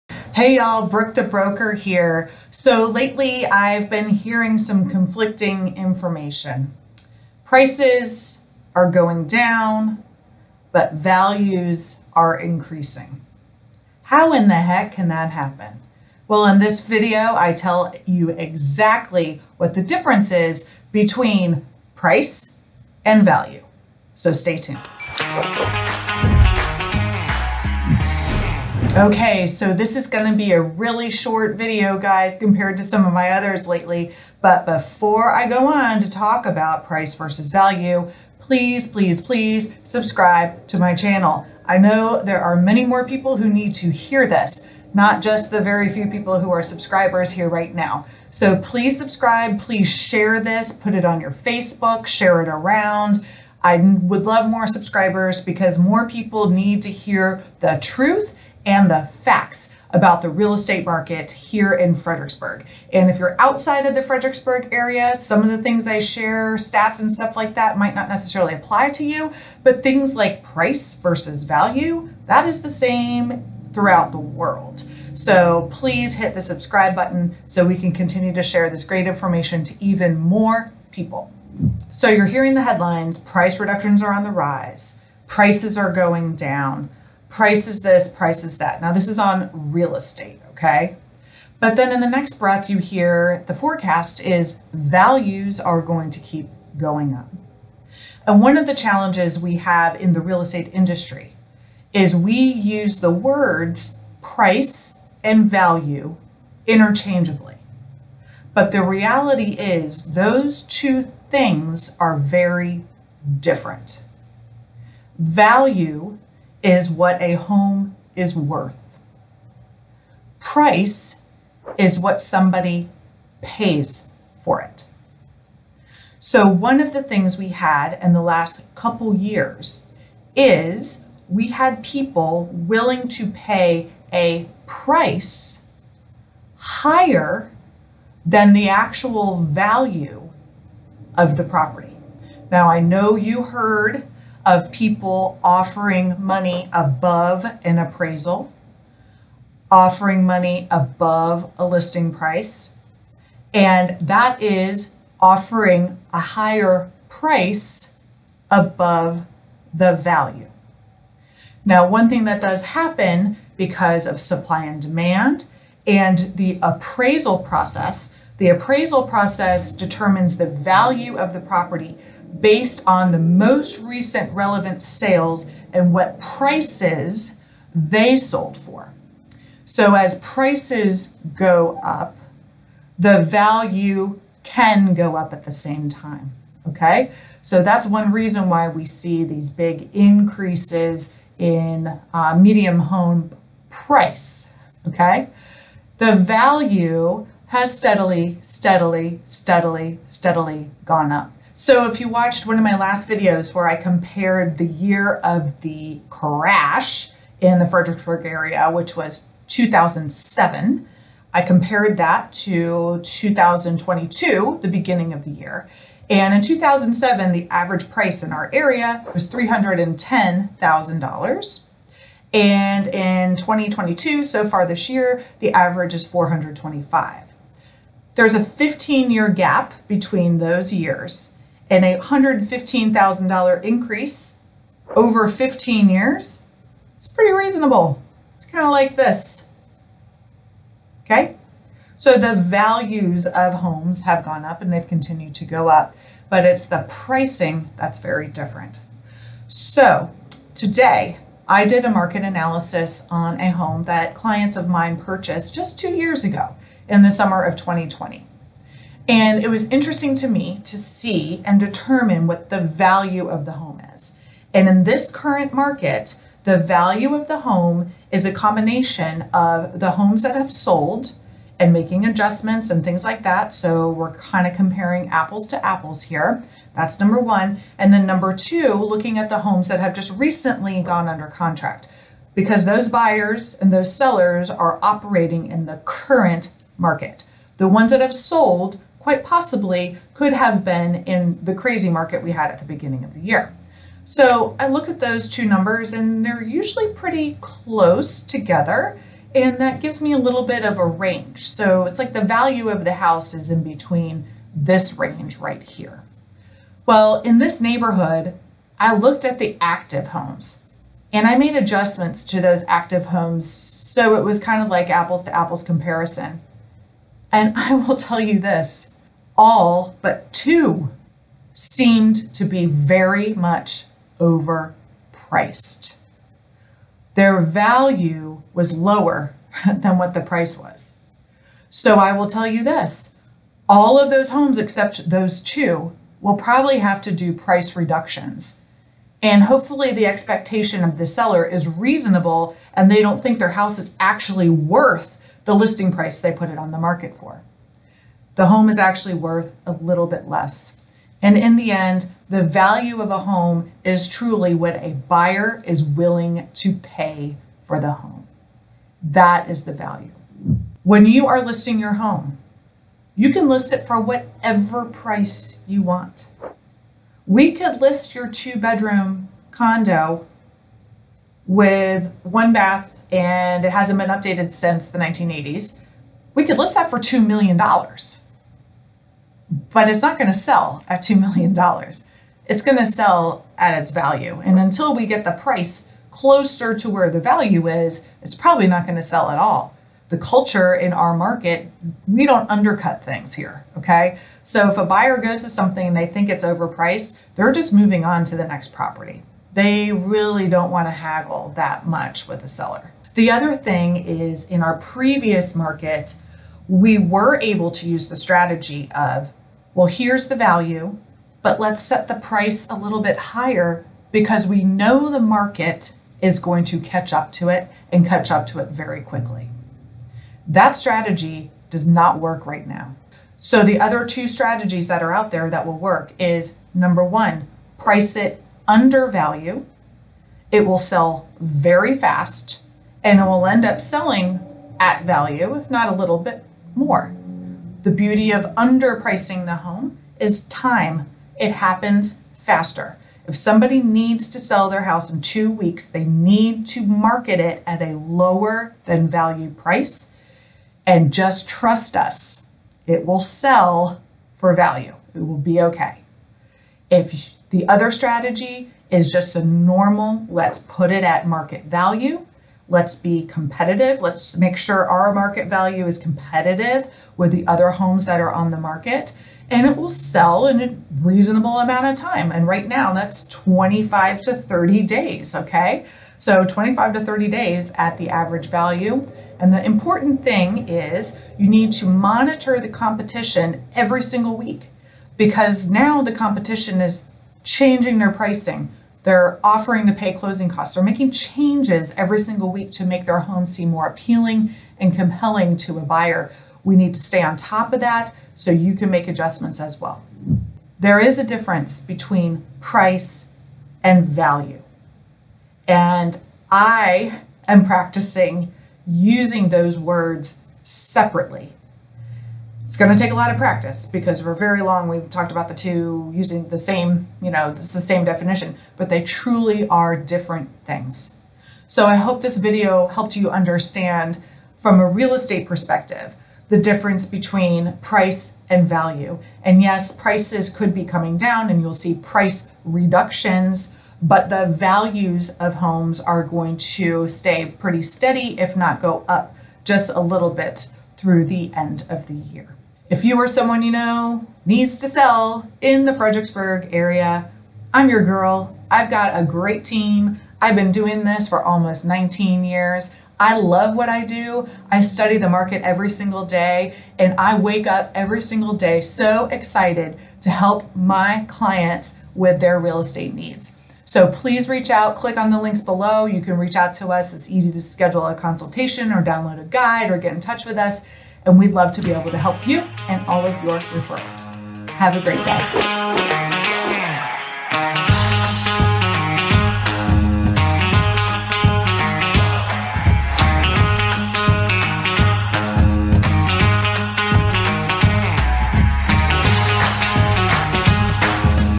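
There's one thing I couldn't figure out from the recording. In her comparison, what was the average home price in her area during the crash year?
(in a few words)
$310,000.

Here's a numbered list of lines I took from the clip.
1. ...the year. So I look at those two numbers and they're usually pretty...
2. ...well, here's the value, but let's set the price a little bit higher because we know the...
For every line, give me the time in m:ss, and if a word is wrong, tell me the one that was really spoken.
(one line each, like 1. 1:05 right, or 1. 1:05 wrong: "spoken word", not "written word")
1. 4:53 right
2. 6:49 right.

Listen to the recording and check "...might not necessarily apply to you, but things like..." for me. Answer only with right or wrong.
right.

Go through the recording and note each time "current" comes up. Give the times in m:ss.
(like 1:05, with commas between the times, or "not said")
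4:25, 4:45.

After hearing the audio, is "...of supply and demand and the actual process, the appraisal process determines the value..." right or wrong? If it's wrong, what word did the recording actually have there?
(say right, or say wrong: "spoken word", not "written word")
wrong: "appraisal", not "actual".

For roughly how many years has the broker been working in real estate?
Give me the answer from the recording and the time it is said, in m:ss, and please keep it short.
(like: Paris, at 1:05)
19 years, at 9:11.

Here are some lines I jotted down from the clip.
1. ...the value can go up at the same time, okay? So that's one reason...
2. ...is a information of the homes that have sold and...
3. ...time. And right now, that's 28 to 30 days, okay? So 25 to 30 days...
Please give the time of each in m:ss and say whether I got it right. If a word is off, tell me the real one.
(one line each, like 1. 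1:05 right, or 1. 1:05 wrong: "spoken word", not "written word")
1. 3:02 right
2. 4:28 wrong: "combination", not "information"
3. 7:51 wrong: "25", not "28".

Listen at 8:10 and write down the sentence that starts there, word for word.
They're making changes every single week to make their home seem more appealing and compelling to a buyer.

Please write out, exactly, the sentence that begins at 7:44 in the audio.
Let's make sure our market value is competitive with the other homes that are on the market.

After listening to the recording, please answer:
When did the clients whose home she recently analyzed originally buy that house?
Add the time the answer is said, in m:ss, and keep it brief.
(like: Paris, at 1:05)
summer of 2020, at 4:17.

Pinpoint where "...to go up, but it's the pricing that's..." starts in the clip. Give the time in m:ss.
4:05.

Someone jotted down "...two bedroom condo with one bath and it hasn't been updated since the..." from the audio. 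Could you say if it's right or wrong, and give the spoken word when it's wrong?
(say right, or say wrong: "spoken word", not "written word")
right.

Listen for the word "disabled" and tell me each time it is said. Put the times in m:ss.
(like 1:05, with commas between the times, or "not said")
not said.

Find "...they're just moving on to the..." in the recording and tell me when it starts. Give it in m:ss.
6:37.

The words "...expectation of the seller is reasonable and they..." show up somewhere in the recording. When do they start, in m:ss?
5:40.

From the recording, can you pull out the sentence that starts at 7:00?
That strategy does not work right now.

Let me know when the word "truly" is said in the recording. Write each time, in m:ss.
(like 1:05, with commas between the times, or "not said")
5:54, 8:39.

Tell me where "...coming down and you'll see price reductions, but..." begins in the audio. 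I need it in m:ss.
8:50.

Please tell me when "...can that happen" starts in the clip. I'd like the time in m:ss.
0:14.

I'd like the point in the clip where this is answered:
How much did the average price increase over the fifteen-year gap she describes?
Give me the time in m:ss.
3:51.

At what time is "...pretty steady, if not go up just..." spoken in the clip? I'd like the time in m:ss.
8:57.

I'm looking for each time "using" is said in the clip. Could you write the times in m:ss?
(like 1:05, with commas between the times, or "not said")
8:28, 8:36.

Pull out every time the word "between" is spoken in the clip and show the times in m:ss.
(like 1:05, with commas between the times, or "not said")
0:20, 3:49, 5:03, 8:21, 8:47.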